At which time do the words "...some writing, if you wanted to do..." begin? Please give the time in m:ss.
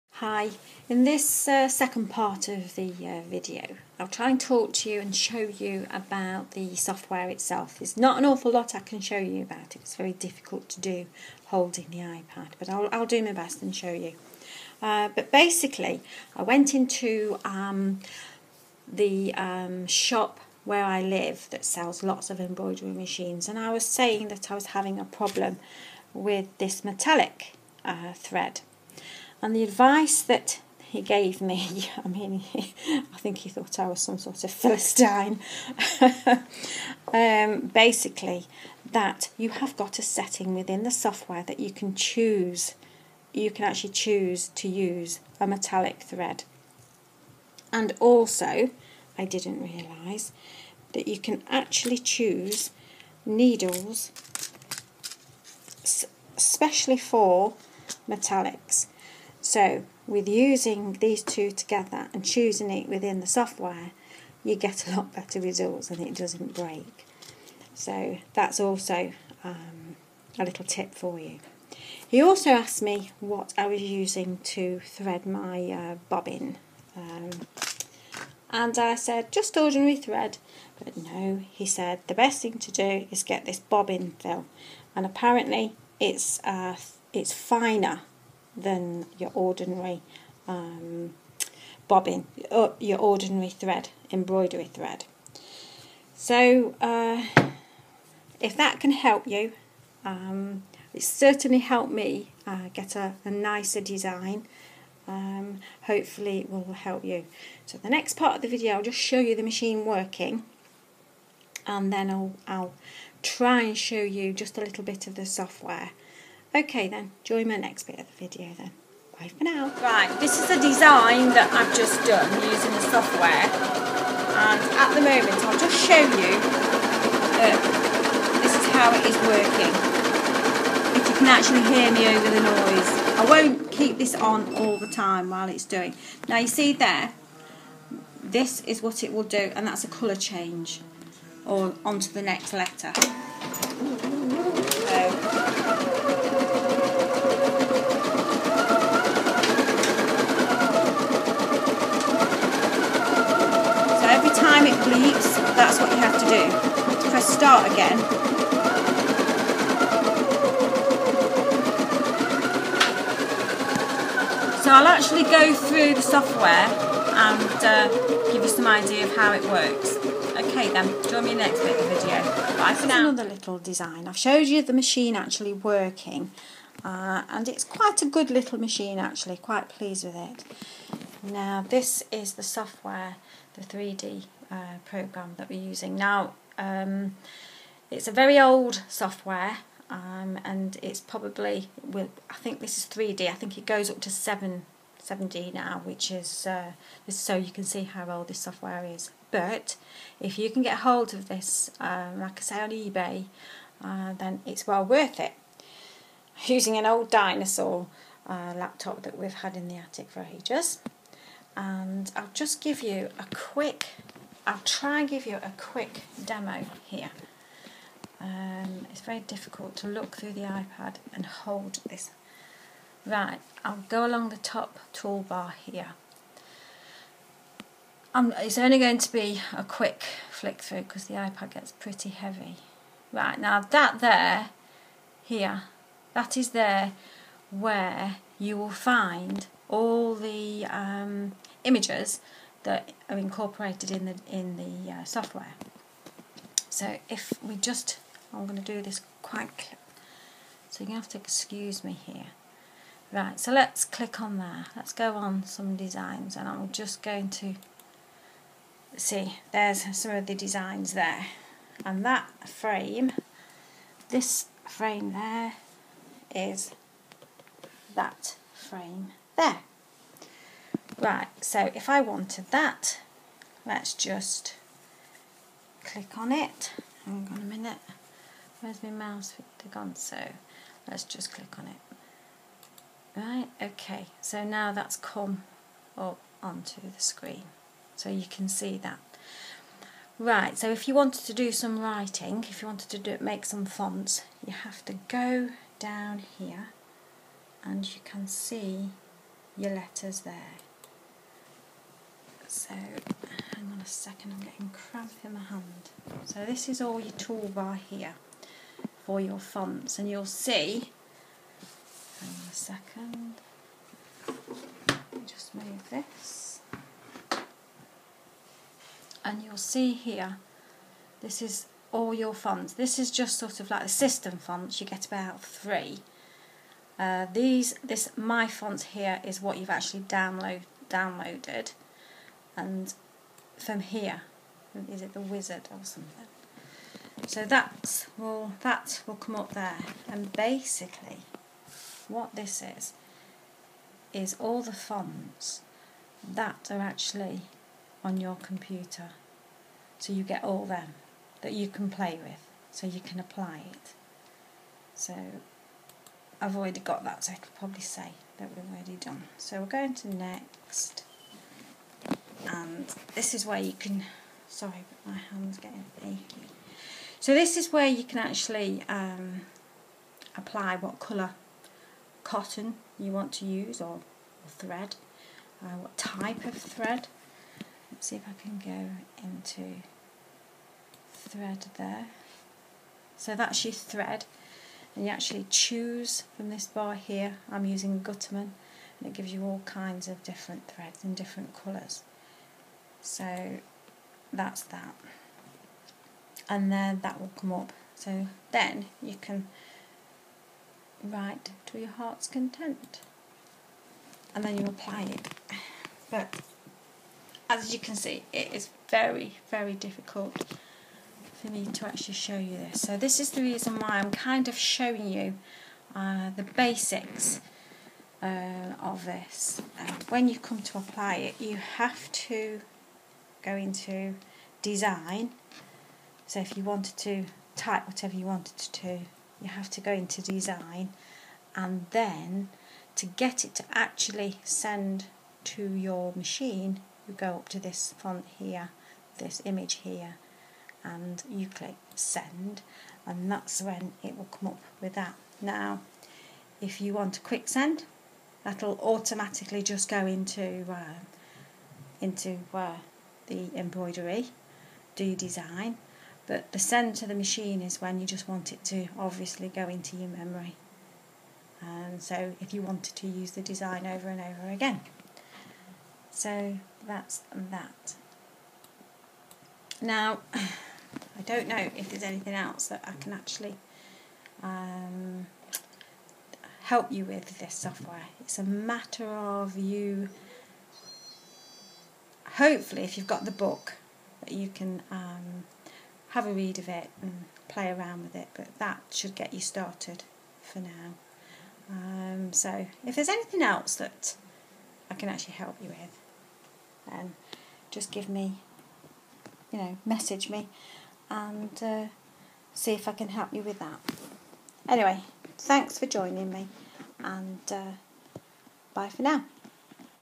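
4:51.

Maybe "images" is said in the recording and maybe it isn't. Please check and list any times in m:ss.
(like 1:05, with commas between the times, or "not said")
4:01, 7:19.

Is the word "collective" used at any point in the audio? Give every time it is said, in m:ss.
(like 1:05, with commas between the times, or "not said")
not said.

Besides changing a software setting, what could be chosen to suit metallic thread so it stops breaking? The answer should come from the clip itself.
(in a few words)
Needles.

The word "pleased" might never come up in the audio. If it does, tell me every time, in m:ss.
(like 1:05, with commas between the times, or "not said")
2:59.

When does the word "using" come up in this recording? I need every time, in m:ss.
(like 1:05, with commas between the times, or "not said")
1:00, 1:13, 2:02, 3:05, 3:26, 6:27.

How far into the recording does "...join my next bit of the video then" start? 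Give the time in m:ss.
1:57.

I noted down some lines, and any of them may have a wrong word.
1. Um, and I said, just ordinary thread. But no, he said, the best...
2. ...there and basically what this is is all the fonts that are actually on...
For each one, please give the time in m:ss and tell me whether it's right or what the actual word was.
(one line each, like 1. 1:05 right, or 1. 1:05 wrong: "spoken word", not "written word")
1. 1:16 right
2. 5:39 right.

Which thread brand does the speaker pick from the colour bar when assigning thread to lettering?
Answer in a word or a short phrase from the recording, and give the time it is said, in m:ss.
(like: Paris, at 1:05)
Gütermann, at 6:28.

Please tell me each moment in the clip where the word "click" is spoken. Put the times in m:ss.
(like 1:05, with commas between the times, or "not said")
4:13, 4:35, 4:41, 7:21.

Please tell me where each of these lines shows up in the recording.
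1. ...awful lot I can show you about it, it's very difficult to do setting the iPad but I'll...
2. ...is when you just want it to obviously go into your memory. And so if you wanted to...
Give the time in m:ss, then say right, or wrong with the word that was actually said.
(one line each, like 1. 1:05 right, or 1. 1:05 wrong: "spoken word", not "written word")
1. 0:08 wrong: "holding", not "setting"
2. 7:37 right.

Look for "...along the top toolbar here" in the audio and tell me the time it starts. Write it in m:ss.
3:44.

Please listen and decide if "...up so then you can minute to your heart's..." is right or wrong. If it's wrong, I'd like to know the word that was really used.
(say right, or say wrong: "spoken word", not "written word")
wrong: "write", not "minute".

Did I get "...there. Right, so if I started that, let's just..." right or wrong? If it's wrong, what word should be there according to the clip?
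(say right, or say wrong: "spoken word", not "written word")
wrong: "wanted", not "started".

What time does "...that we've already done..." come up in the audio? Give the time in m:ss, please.
5:58.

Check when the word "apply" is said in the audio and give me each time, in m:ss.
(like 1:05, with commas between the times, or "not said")
5:53, 6:10, 6:44, 7:00.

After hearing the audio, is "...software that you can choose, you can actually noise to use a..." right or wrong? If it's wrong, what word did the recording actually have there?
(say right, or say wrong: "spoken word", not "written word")
wrong: "choose", not "noise".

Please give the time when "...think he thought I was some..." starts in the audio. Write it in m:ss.
0:33.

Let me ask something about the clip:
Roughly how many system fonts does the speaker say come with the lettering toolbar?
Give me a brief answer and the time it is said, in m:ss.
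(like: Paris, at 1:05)
3, at 5:25.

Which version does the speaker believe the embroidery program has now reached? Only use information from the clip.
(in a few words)
7D.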